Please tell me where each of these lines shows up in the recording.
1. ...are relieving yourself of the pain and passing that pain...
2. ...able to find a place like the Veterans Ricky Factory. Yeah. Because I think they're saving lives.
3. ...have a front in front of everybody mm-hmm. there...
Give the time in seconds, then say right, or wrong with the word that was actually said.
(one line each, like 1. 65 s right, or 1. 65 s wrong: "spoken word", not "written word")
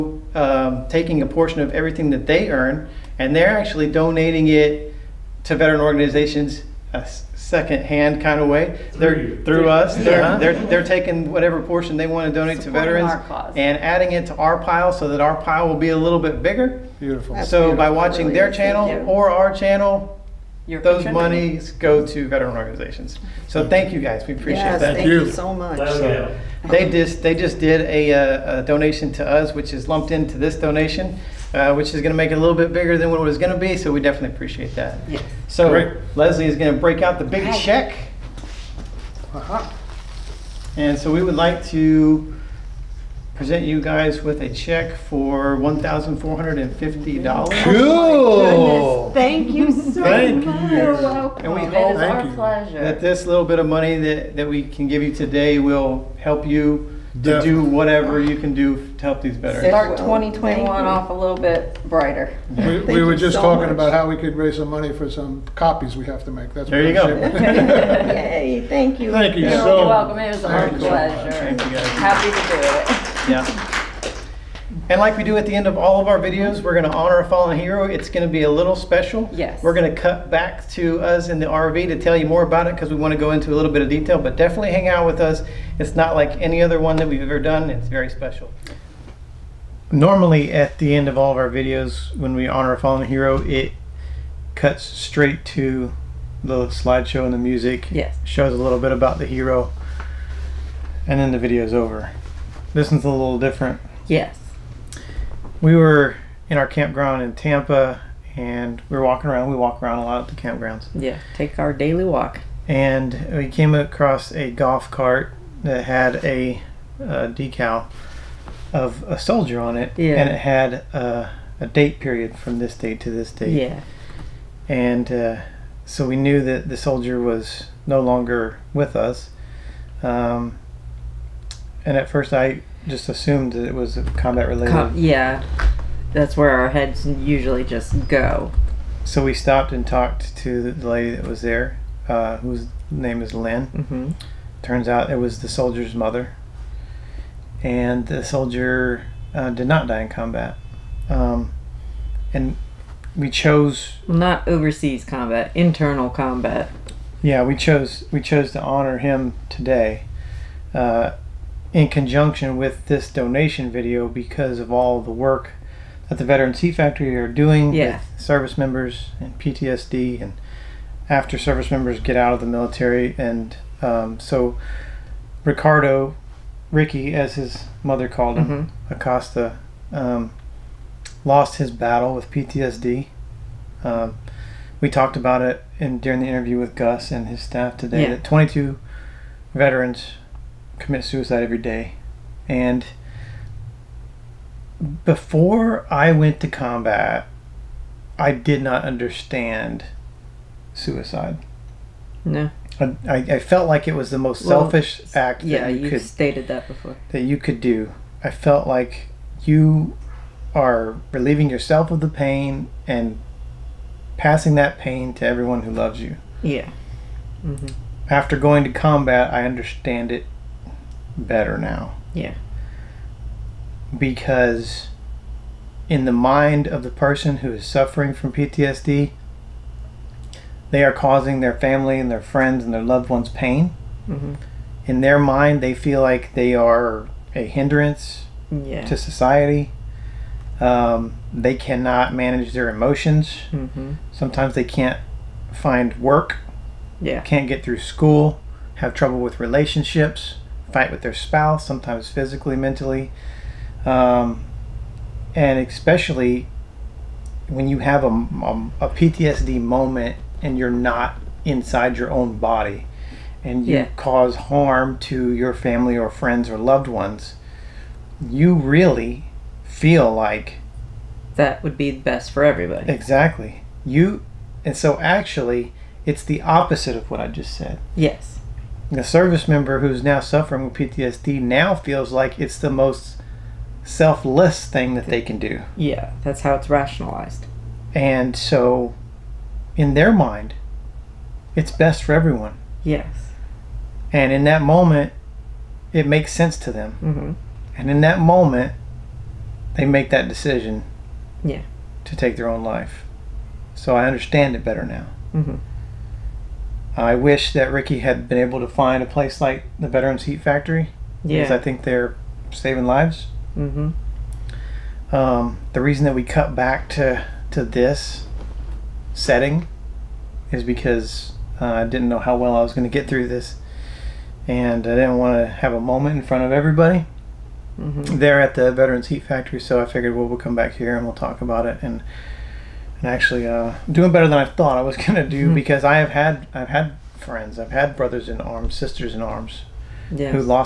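1. 210 s right
2. 308 s wrong: "Heat", not "Ricky"
3. 325 s wrong: "moment", not "front".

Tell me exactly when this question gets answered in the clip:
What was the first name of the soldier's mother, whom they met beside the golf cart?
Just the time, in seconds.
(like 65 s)
143 s.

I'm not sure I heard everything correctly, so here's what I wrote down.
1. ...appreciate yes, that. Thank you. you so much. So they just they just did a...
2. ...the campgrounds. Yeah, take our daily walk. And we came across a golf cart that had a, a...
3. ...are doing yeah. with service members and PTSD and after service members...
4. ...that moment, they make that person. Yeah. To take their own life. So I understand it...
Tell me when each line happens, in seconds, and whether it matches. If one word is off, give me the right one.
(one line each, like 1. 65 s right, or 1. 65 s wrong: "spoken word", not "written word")
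1. 24 s right
2. 110 s right
3. 167 s right
4. 297 s wrong: "decision", not "person".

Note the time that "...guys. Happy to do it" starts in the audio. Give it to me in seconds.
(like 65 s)
71 s.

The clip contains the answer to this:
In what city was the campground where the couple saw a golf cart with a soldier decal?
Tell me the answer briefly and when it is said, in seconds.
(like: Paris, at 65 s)
Tampa, at 107 s.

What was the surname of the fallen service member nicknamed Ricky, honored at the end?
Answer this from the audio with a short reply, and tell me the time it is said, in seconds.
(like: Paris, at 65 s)
Acosta, at 178 s.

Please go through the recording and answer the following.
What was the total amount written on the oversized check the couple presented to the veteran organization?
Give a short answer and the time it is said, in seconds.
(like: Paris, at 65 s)
$1,450, at 45 s.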